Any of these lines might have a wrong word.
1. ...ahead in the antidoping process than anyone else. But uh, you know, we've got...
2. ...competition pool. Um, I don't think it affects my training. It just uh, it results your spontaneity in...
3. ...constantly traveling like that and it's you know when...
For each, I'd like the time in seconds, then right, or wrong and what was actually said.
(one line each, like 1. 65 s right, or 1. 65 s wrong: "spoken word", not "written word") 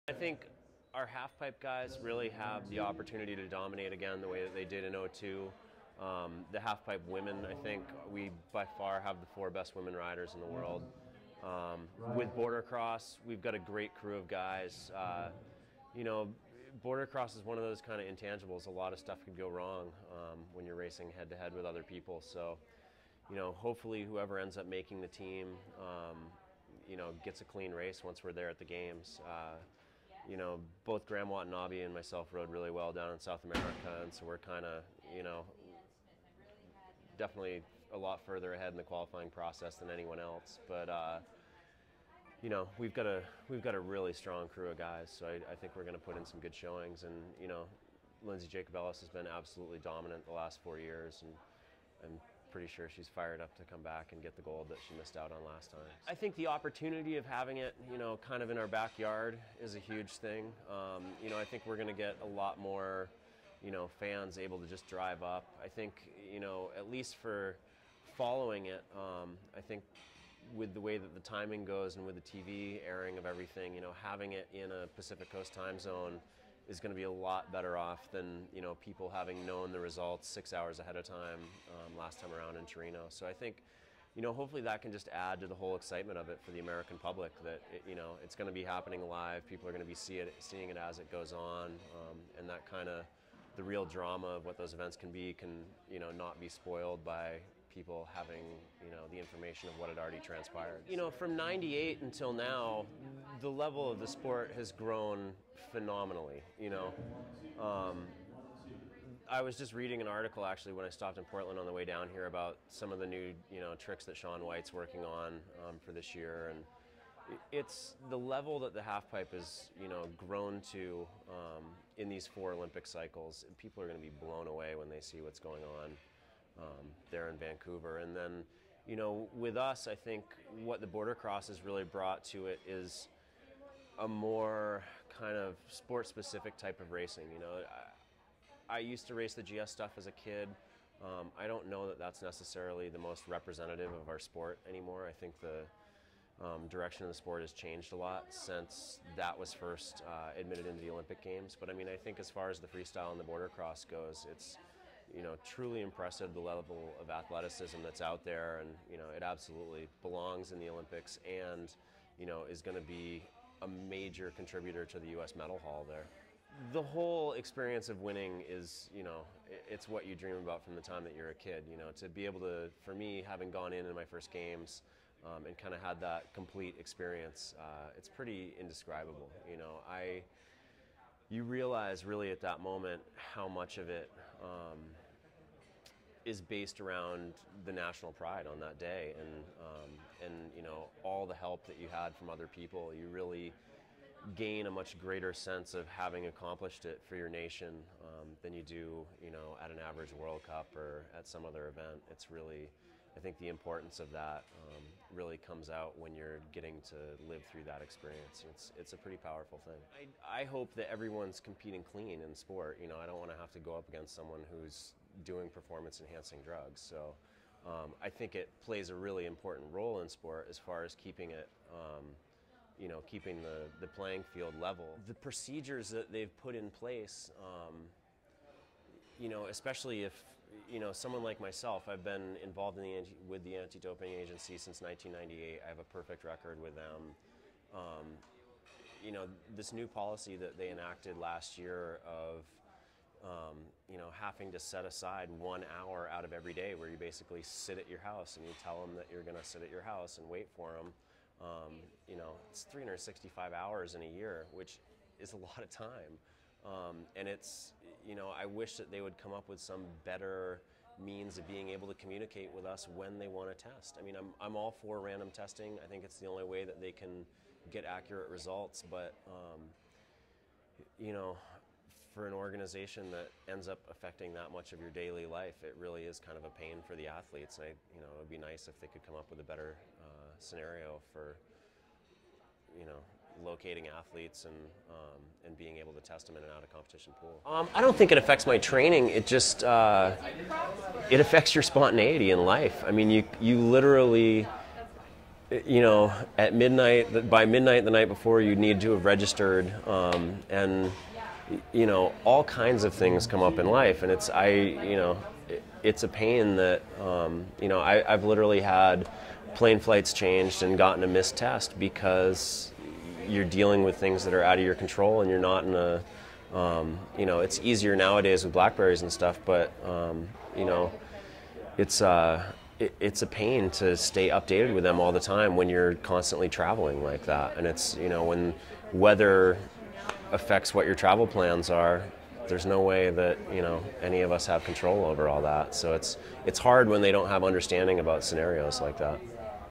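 1. 38 s wrong: "qualifying", not "antidoping"
2. 286 s wrong: "affects", not "results"
3. 325 s right.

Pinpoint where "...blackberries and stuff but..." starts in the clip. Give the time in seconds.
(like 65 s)
318 s.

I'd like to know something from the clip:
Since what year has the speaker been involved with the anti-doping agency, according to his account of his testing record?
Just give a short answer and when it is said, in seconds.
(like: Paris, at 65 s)
1998, at 234 s.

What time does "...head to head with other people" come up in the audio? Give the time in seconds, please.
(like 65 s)
21 s.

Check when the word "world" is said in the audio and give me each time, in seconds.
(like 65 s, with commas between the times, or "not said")
10 s, 200 s.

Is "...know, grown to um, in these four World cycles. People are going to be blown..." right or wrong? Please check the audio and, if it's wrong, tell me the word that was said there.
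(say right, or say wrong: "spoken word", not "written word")
wrong: "Olympic", not "World".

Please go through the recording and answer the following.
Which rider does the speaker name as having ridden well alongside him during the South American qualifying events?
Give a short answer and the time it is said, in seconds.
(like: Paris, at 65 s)
Graham Watanabe, at 31 s.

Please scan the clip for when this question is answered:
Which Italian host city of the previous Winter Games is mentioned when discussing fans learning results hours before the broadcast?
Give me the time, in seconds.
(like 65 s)
82 s.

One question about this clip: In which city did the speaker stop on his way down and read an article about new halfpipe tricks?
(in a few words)
Portland.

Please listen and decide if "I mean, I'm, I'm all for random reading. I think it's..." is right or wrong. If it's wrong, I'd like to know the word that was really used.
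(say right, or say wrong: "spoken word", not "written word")
wrong: "testing", not "reading".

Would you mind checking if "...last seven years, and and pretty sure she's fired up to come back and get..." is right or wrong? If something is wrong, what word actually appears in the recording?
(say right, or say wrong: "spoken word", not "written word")
wrong: "four", not "seven".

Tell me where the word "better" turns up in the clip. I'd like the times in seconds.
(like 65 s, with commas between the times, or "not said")
77 s, 260 s, 279 s.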